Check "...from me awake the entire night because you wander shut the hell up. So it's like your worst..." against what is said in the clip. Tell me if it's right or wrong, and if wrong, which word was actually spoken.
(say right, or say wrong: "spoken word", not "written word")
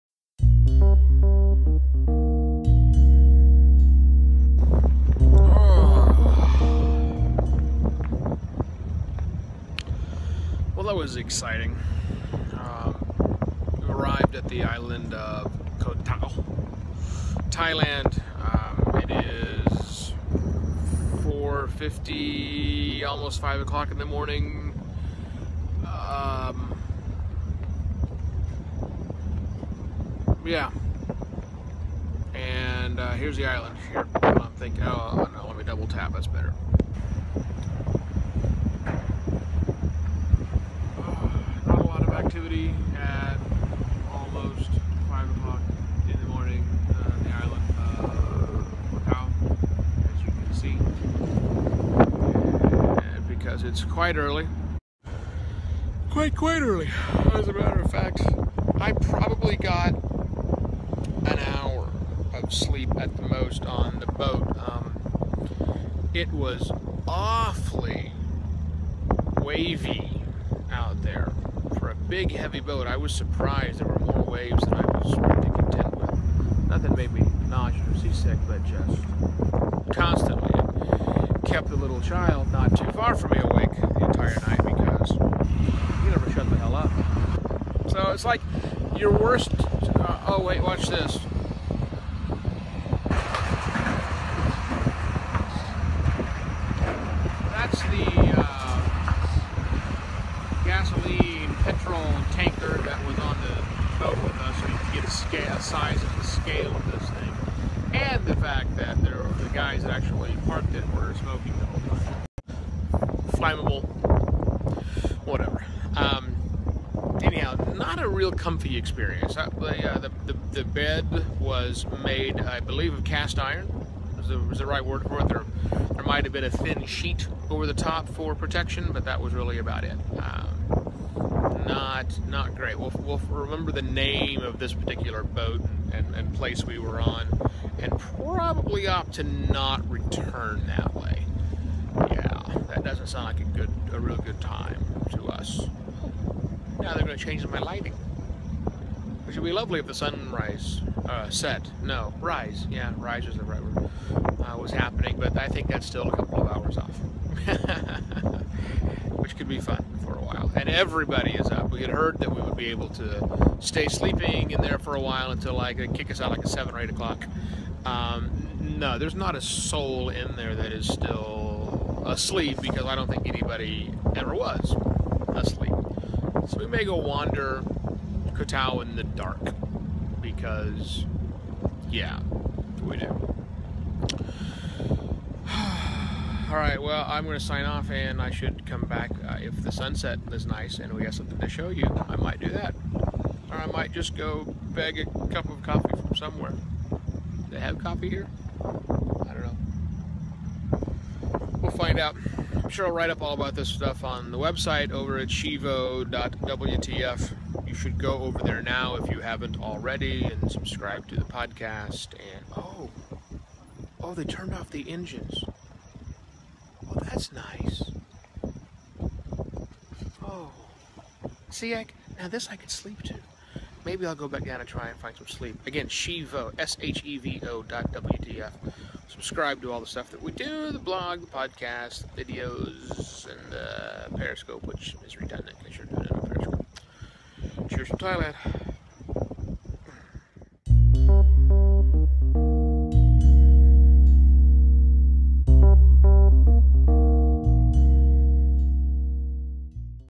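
wrong: "never", not "wander".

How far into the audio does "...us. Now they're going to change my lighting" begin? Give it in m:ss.
2:25.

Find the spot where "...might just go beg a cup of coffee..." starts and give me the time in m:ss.
3:13.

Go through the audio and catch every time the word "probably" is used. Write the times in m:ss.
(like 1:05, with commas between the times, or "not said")
0:58, 2:18.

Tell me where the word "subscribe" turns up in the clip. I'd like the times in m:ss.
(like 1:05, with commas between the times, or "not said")
3:30, 3:49.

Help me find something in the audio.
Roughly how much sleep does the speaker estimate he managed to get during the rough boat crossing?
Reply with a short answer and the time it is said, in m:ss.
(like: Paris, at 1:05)
an hour, at 1:01.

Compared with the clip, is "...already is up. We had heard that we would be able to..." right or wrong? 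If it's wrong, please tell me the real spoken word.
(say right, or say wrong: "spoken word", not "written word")
wrong: "everybody", not "already".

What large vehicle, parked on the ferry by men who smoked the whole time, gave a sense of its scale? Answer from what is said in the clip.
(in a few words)
petrol tanker.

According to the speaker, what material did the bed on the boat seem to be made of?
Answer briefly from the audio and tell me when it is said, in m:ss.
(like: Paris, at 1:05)
cast iron, at 2:03.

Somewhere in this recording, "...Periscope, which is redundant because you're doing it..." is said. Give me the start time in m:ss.
3:54.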